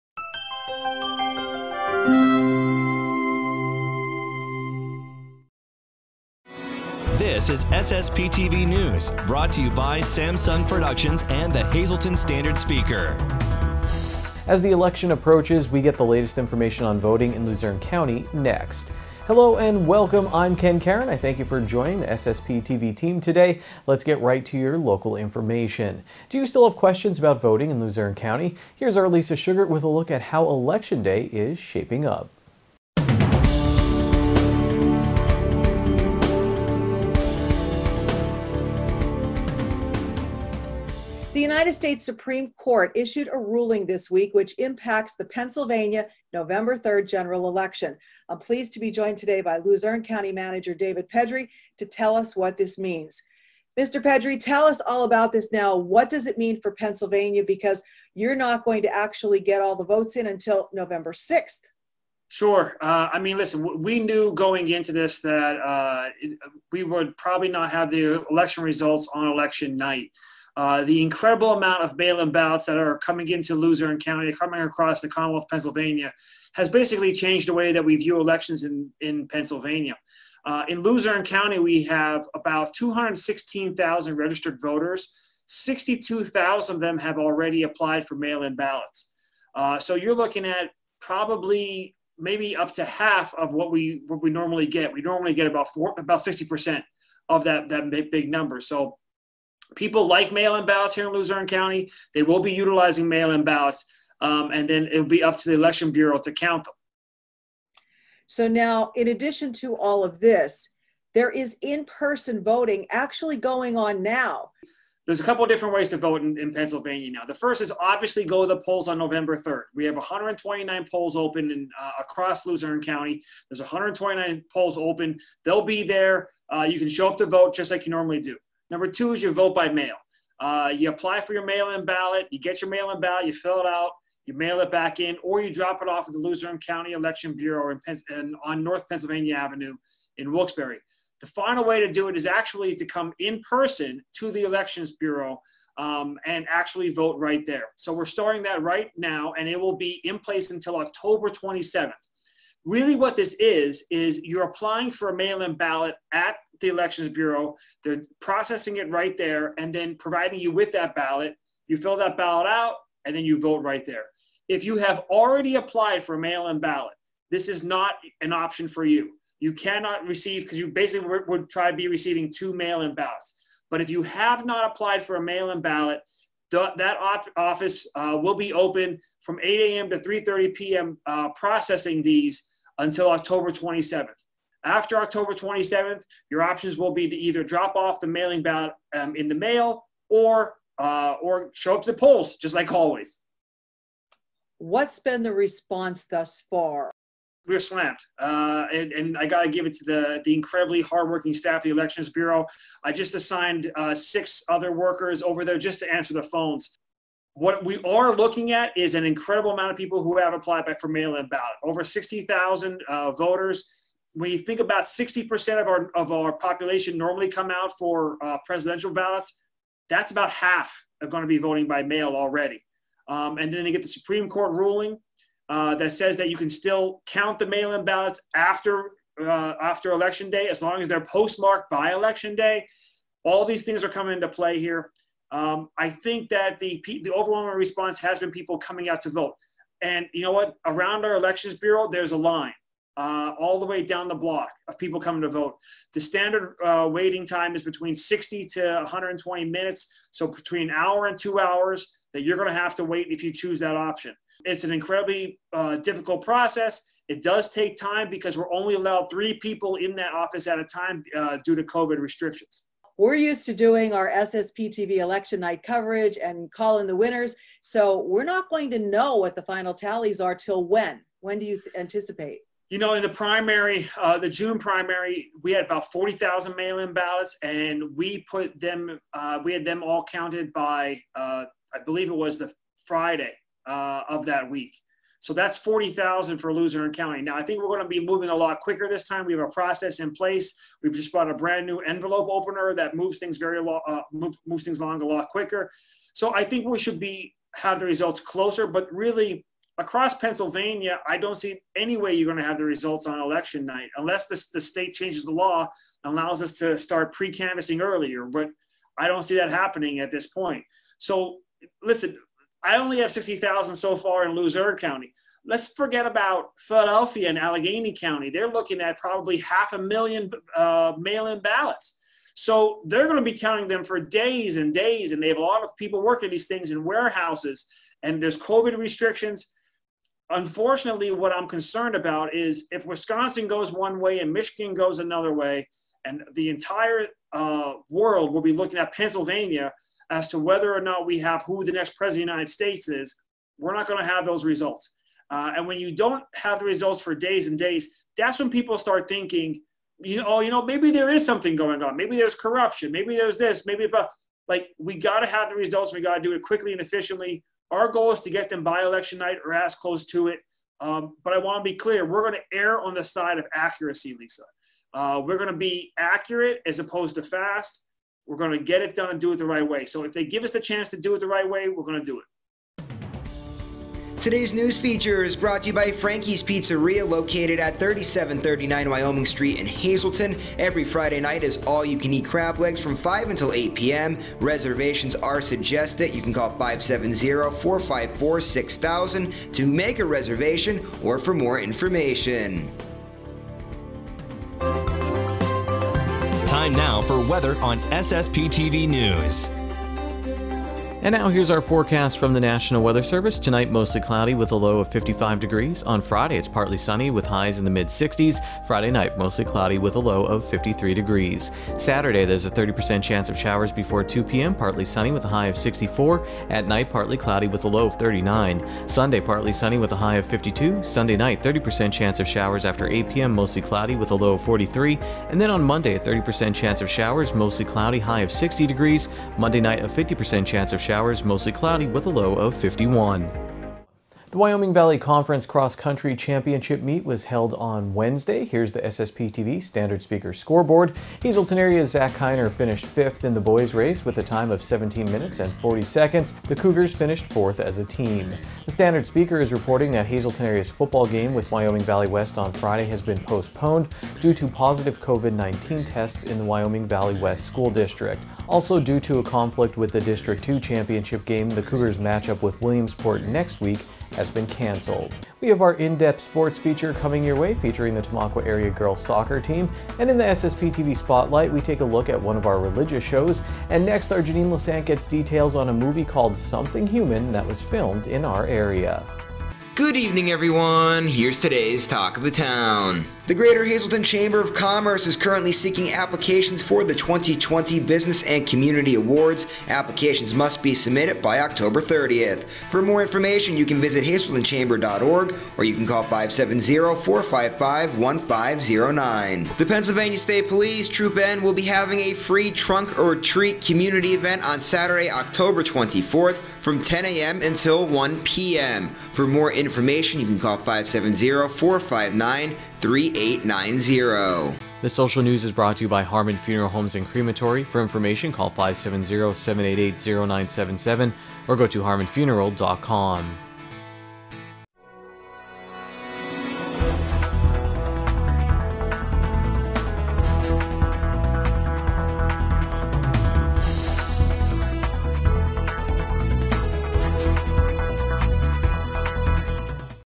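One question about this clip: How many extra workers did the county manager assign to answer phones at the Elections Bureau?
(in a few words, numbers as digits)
6.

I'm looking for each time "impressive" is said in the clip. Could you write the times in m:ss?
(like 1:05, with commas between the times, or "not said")
not said.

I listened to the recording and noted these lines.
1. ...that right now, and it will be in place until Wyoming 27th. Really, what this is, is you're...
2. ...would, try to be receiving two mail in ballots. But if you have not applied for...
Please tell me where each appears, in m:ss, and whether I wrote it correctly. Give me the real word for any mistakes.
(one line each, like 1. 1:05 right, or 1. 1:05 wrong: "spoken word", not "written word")
1. 2:28 wrong: "October", not "Wyoming"
2. 2:51 right.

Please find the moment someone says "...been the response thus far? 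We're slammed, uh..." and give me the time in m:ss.
3:14.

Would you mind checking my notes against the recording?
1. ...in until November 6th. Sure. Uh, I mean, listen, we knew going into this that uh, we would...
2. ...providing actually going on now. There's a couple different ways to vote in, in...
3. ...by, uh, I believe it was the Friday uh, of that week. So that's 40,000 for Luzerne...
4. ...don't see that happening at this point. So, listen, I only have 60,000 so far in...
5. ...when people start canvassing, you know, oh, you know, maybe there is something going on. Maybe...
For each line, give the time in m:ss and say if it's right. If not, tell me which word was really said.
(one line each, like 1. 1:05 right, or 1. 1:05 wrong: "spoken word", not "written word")
1. 1:00 right
2. 1:52 wrong: "voting", not "providing"
3. 4:40 right
4. 5:09 right
5. 5:48 wrong: "thinking", not "canvassing".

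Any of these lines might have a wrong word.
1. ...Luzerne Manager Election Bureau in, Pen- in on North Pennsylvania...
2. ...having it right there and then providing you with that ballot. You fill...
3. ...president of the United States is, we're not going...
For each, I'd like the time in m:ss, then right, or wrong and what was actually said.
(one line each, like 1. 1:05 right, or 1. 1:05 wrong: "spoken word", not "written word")
1. 2:16 wrong: "County", not "Manager"
2. 2:38 wrong: "processing", not "having"
3. 5:41 right.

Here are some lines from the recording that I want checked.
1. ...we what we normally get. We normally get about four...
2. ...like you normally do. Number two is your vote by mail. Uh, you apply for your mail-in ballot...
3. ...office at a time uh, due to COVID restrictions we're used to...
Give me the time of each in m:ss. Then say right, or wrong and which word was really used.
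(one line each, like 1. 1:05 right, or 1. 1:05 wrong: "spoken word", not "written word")
1. 1:33 right
2. 2:07 right
3. 4:20 right.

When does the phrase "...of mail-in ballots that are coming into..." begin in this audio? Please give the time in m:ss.
1:11.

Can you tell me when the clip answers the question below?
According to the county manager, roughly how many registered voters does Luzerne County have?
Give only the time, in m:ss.
1:22.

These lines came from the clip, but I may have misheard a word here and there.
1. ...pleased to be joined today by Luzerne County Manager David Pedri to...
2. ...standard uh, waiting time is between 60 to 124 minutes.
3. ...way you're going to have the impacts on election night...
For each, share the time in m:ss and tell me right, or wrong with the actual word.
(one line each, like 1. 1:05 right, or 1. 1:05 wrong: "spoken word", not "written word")
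1. 0:48 right
2. 4:06 wrong: "120", not "124"
3. 5:01 wrong: "results", not "impacts".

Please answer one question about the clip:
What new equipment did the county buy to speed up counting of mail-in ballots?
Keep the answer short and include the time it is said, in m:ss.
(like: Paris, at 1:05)
envelope opener, at 4:51.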